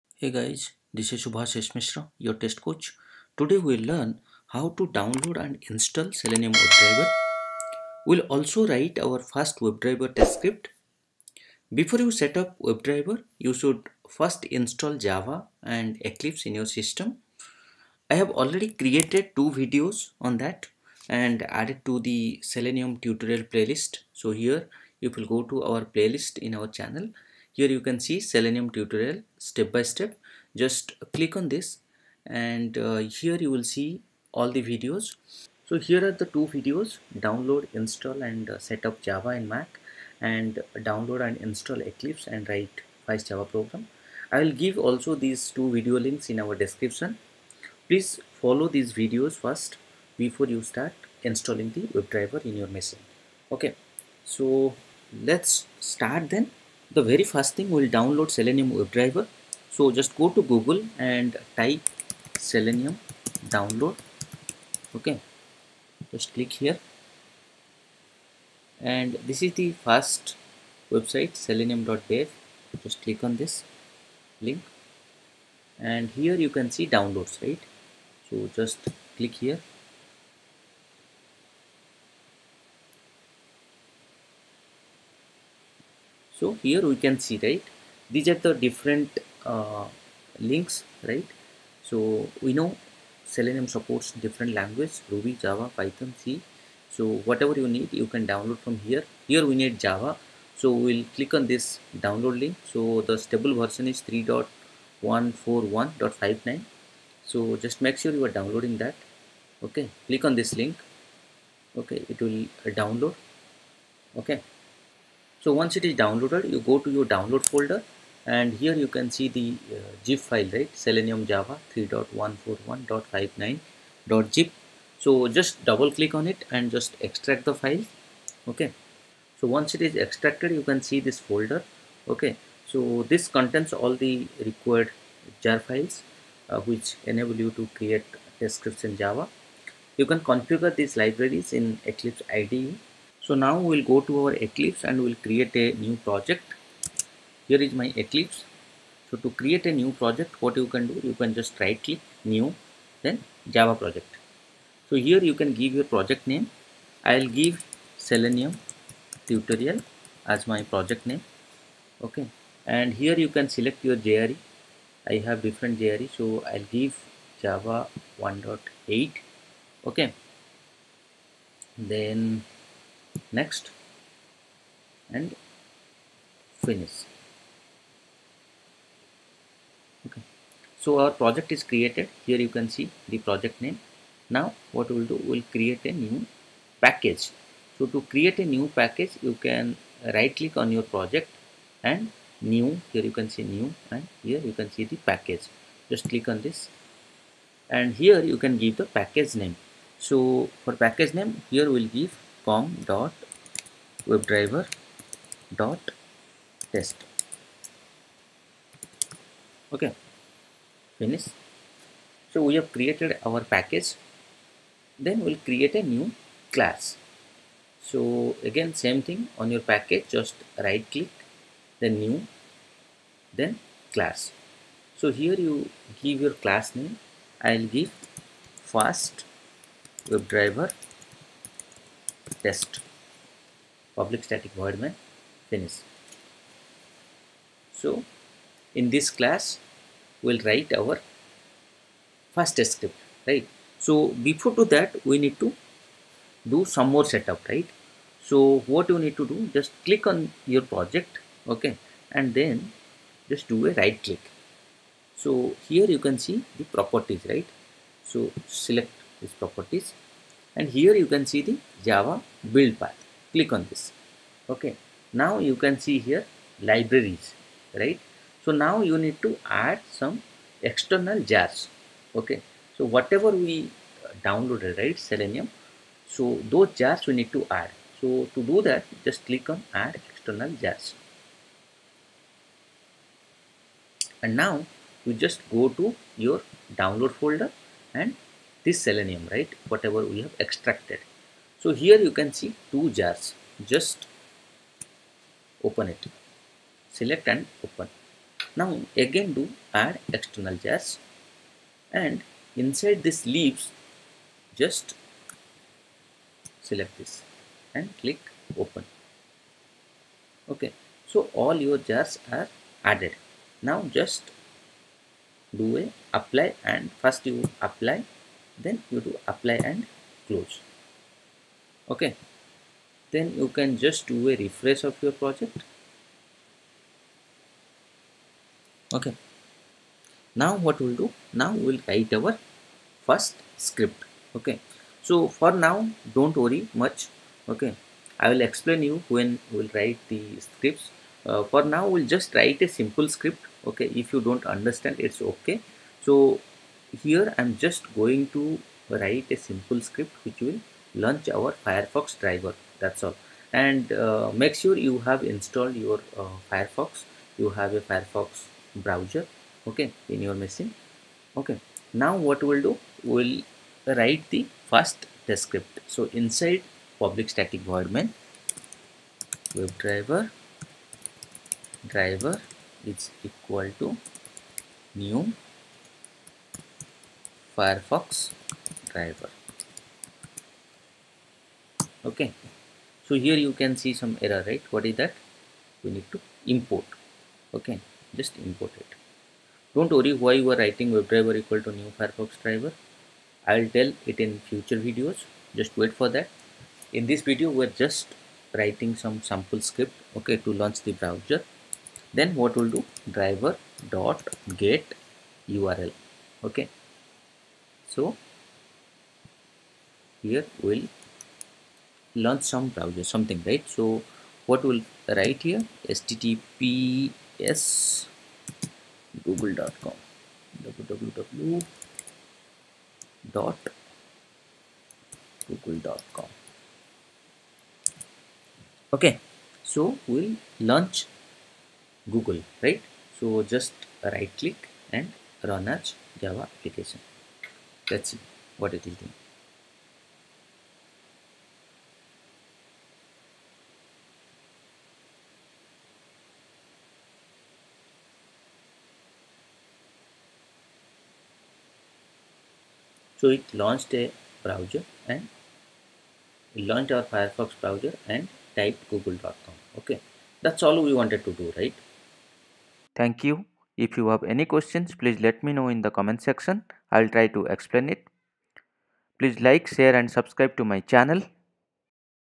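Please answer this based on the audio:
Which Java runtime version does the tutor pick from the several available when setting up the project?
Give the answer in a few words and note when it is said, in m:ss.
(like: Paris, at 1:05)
Java 1.8, at 2:47.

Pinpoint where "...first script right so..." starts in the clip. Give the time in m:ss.
4:02.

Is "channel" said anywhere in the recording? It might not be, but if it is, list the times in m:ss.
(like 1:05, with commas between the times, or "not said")
0:26, 7:50.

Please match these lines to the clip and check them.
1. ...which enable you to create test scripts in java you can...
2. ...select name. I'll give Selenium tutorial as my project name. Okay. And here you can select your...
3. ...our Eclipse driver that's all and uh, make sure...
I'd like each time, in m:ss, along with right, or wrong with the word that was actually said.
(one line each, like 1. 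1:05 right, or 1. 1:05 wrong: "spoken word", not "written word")
1. 2:16 right
2. 2:35 wrong: "project", not "select"
3. 5:51 wrong: "Firefox", not "Eclipse".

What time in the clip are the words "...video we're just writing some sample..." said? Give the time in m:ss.
6:37.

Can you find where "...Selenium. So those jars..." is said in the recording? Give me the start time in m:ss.
4:34.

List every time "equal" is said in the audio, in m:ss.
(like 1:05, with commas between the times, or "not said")
6:13, 6:31.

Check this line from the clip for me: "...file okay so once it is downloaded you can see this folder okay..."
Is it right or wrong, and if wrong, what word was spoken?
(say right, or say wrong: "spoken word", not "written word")
wrong: "extracted", not "downloaded".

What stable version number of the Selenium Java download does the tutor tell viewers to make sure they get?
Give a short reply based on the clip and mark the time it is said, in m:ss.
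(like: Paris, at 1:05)
3.141.59, at 1:44.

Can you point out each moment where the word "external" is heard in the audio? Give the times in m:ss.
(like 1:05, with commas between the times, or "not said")
4:30, 4:40, 5:00.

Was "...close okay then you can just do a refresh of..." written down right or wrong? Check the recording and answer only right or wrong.
right.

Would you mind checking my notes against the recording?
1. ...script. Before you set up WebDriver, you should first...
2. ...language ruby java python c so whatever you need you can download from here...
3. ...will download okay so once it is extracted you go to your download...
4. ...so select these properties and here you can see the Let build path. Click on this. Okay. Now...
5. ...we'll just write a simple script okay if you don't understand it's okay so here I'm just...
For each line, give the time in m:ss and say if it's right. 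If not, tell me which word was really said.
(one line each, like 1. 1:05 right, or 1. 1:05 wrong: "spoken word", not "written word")
1. 0:10 right
2. 1:34 right
3. 1:52 wrong: "downloaded", not "extracted"
4. 4:18 wrong: "Java", not "Let"
5. 5:41 right.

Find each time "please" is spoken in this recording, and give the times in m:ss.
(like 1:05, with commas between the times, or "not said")
0:47, 7:44, 7:49.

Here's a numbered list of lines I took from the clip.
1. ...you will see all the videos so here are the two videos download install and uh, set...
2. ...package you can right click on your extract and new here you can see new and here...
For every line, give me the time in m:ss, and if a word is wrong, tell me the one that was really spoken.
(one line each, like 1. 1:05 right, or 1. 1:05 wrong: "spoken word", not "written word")
1. 0:33 right
2. 3:08 wrong: "project", not "extract".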